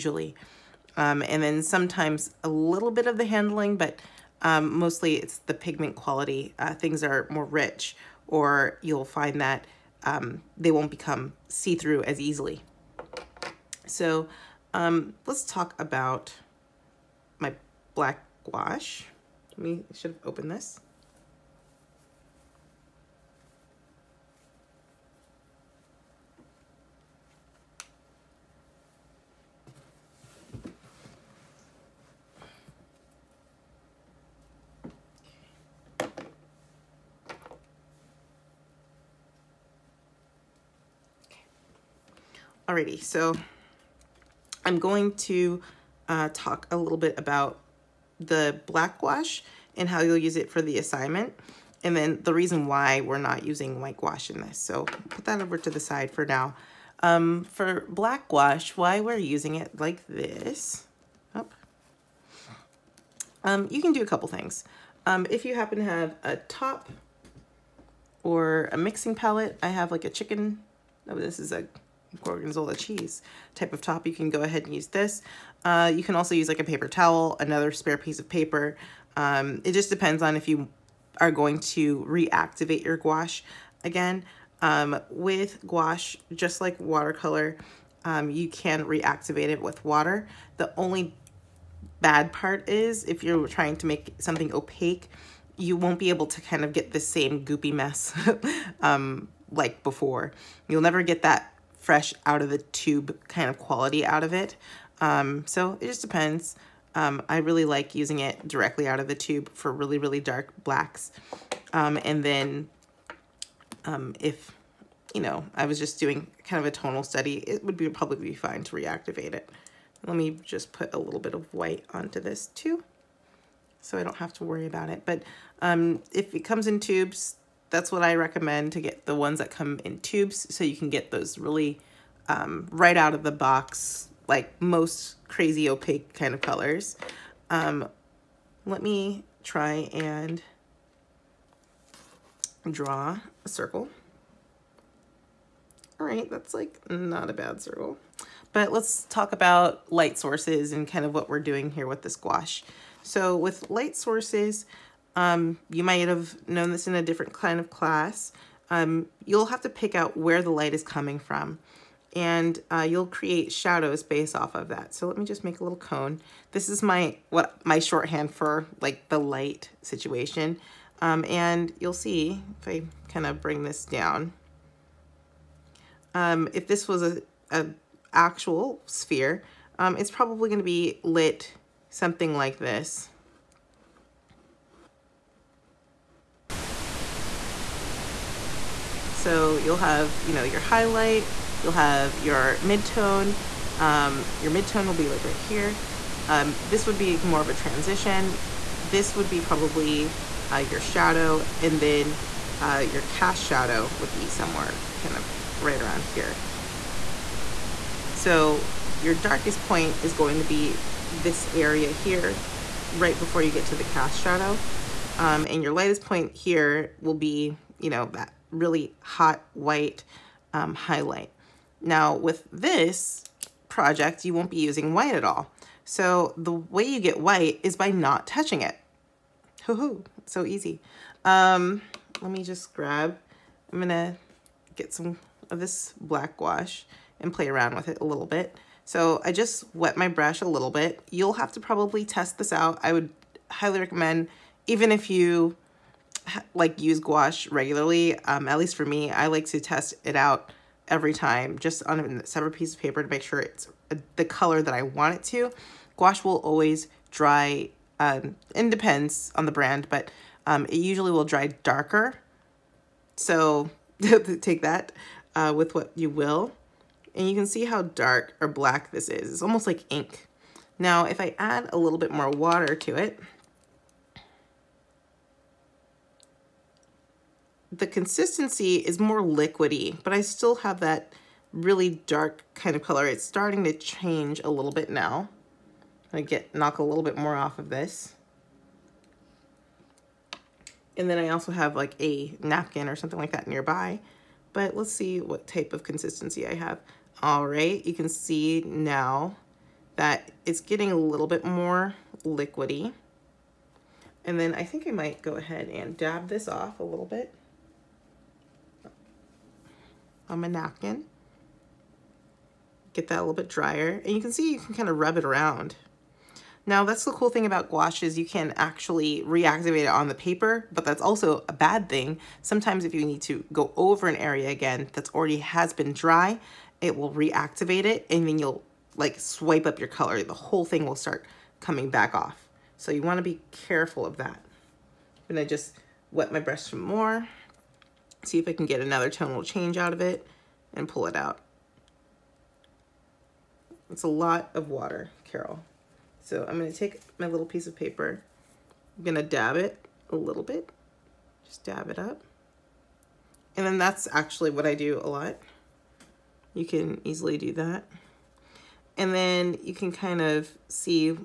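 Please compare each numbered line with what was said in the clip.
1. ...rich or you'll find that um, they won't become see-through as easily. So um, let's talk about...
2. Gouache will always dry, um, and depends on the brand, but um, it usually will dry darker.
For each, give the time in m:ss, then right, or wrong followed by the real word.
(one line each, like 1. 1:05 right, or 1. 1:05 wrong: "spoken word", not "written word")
1. 0:07 right
2. 4:15 right.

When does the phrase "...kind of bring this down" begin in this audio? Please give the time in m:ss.
2:53.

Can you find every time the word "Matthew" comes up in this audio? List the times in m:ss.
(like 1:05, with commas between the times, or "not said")
not said.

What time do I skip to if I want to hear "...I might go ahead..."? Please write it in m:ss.
5:04.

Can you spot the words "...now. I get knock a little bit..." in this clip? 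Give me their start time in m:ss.
4:44.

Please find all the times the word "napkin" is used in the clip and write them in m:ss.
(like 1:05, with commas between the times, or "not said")
4:52, 5:10.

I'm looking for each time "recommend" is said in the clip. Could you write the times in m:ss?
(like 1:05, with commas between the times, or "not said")
2:08, 4:03.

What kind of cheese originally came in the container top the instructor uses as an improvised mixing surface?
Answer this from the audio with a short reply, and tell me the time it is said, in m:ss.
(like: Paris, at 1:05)
gorgonzola, at 1:12.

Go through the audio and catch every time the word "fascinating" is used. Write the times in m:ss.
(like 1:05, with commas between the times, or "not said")
not said.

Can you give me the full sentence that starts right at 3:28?
So your darkest point is going to be this area here right before you get to the cast shadow.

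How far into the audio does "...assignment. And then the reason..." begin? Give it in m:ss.
0:50.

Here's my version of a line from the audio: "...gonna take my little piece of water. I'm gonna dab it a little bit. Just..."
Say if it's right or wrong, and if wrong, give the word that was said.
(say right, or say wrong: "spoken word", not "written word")
wrong: "paper", not "water".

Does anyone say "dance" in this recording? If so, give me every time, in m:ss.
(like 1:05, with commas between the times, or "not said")
not said.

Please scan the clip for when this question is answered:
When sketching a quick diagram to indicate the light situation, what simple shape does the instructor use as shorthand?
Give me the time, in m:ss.
2:45.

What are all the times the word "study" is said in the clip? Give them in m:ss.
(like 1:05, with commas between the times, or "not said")
1:57.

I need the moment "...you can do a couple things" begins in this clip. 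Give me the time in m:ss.
1:03.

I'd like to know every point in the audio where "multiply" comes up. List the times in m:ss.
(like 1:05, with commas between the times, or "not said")
not said.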